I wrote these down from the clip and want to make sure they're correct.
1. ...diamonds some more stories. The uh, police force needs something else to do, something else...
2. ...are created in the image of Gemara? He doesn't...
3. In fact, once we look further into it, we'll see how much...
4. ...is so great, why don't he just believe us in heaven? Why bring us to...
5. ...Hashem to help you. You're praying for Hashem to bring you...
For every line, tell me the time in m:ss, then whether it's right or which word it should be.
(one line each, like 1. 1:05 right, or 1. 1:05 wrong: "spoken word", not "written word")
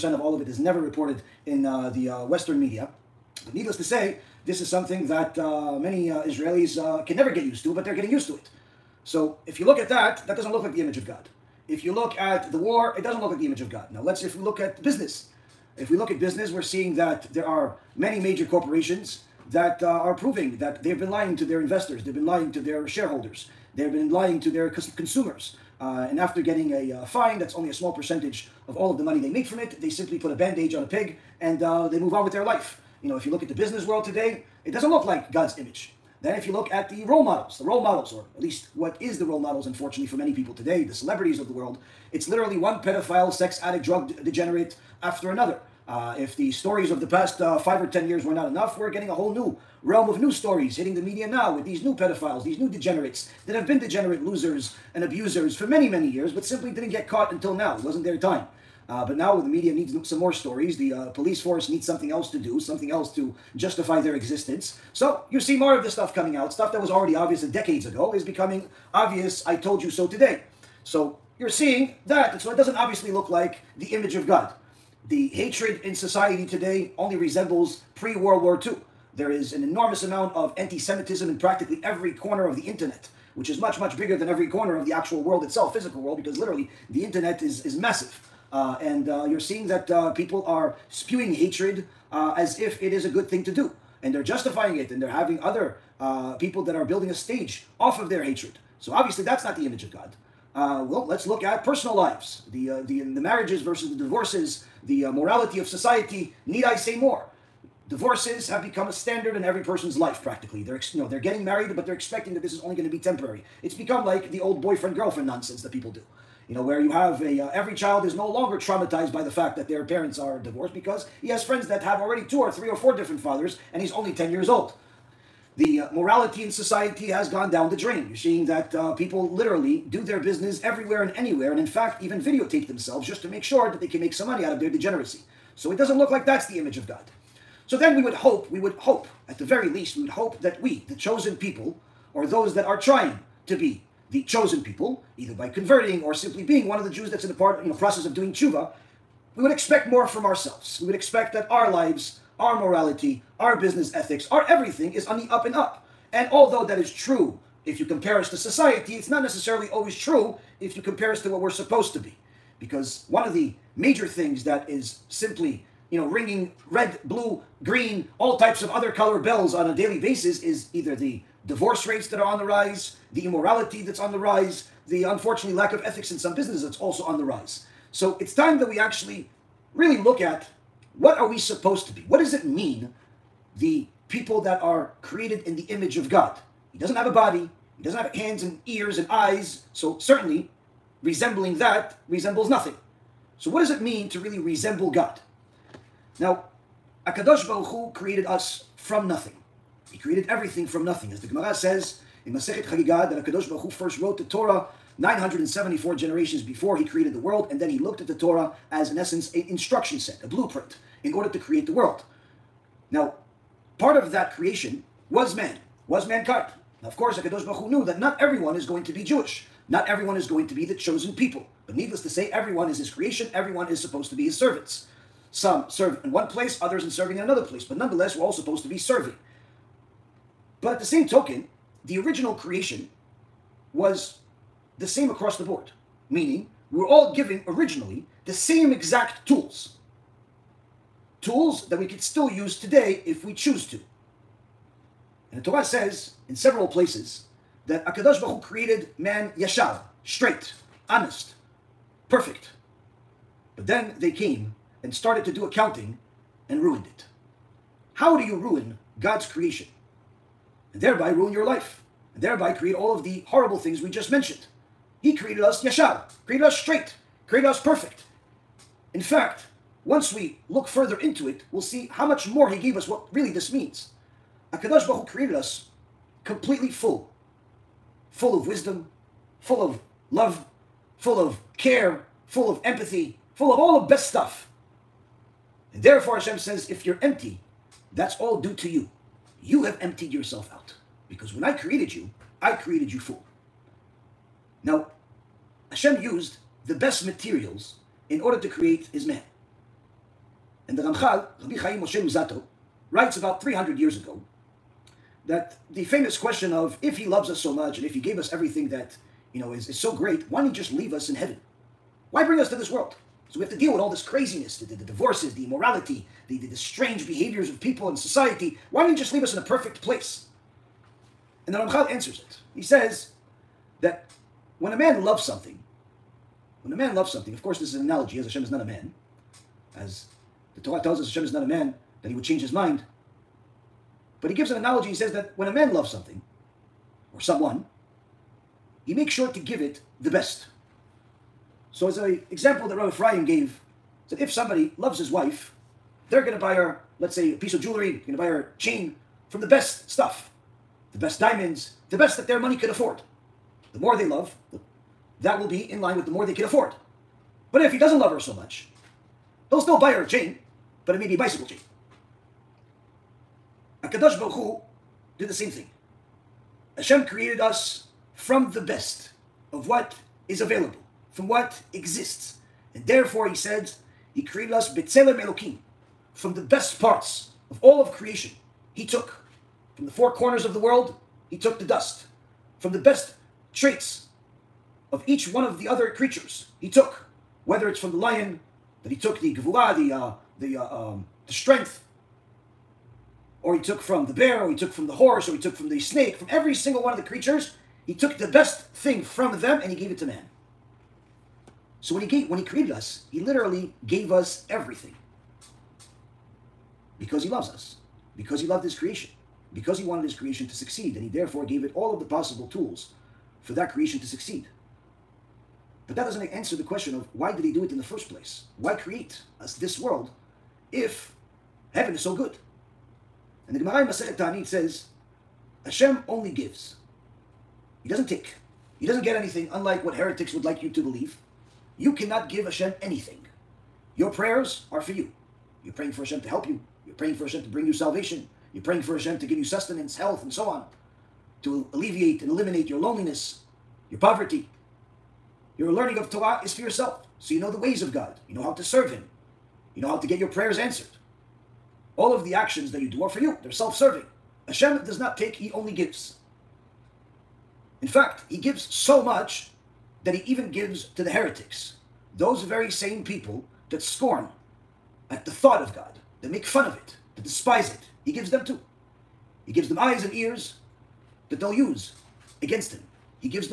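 1. 0:59 wrong: "needs", not "diamonds"
2. 3:04 wrong: "God", not "Gemara"
3. 4:28 right
4. 5:09 wrong: "leave", not "believe"
5. 7:16 right.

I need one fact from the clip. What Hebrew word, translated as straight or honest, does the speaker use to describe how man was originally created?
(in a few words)
yeshar.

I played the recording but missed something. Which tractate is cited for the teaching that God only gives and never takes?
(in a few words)
Masechet Ta'anit.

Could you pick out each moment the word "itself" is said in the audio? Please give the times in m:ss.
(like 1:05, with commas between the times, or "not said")
1:25.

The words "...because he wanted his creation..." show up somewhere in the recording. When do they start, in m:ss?
6:49.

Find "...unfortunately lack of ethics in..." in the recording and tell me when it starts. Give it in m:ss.
2:55.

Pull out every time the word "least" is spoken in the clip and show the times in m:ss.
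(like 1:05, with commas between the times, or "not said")
0:38, 2:19.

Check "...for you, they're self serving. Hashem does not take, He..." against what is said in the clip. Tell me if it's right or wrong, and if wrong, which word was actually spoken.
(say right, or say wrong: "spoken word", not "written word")
right.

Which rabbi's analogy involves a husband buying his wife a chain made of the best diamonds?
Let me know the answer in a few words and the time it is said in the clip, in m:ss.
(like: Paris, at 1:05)
Rabbi Ephraim, at 5:42.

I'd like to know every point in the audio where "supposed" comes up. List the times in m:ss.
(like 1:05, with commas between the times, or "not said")
2:41, 3:01, 3:43, 3:48.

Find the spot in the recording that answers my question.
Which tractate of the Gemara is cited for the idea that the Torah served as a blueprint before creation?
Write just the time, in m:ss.
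3:22.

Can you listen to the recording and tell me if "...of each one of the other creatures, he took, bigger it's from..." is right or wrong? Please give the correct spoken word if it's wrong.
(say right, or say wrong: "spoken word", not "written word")
wrong: "whether", not "bigger".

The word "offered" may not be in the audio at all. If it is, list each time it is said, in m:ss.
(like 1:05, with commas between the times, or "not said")
not said.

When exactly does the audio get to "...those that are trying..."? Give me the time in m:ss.
2:22.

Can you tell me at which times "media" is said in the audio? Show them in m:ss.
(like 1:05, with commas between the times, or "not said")
0:02, 0:51, 0:59.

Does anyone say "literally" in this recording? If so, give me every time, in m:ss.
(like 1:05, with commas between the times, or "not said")
0:42, 1:26, 2:09, 6:43.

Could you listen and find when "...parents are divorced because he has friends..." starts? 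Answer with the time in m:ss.
1:59.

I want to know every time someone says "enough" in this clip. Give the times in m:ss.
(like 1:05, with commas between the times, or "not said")
0:48.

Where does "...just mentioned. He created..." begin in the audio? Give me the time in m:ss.
4:23.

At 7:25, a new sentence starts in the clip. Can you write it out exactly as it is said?
Your learning of Torah is for yourself.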